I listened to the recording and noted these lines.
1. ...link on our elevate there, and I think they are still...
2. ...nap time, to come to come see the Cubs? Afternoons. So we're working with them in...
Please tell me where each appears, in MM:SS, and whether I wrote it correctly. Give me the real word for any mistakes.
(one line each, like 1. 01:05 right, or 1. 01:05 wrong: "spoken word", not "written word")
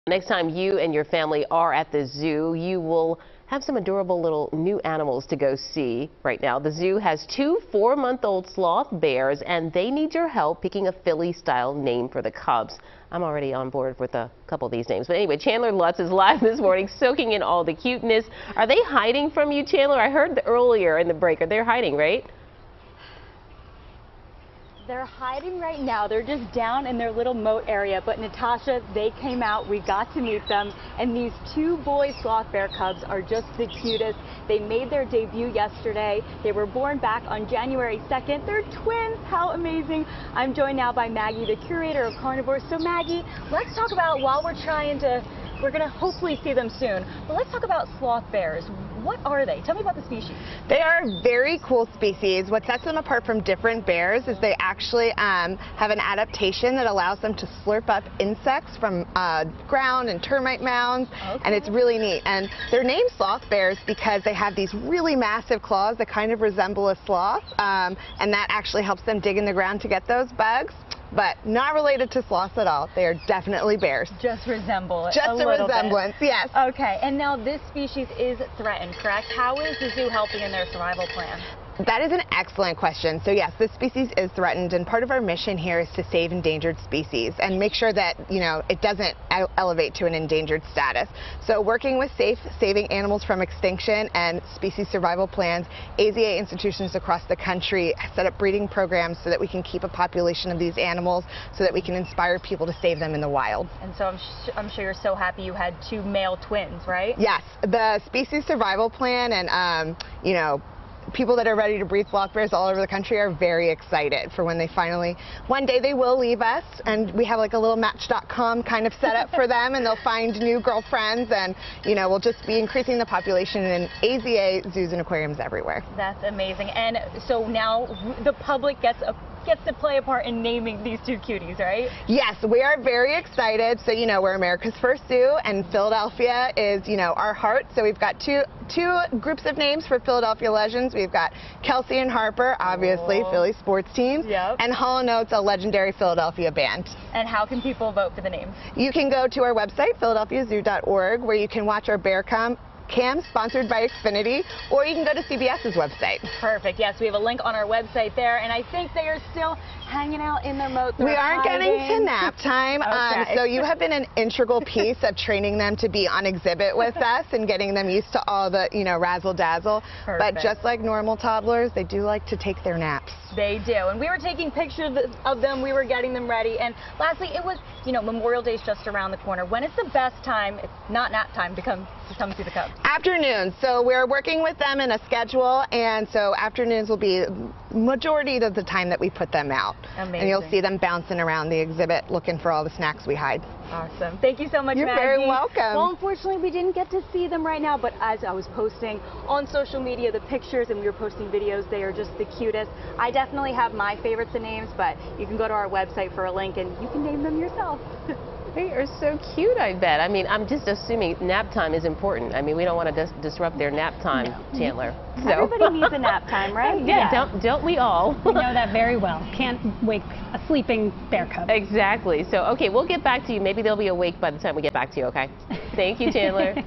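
1. 02:37 wrong: "website", not "elevate"
2. 03:01 right.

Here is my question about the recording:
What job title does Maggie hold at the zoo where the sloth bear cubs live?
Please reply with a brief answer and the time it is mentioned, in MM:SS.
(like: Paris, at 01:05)
curator of carnivores, at 00:41.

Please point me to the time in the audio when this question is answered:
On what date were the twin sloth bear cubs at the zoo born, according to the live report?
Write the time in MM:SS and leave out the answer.
00:37.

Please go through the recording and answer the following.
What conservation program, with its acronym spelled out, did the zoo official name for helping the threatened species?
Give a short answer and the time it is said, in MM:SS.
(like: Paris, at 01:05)
Saving Animals from Extinction, at 01:32.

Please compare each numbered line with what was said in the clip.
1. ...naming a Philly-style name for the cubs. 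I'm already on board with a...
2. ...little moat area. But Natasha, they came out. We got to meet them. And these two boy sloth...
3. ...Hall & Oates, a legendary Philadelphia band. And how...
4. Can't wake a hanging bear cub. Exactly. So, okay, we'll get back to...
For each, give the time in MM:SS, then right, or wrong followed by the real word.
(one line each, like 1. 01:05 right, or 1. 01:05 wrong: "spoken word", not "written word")
1. 00:10 wrong: "picking", not "naming"
2. 00:27 right
3. 02:24 right
4. 03:39 wrong: "sleeping", not "hanging".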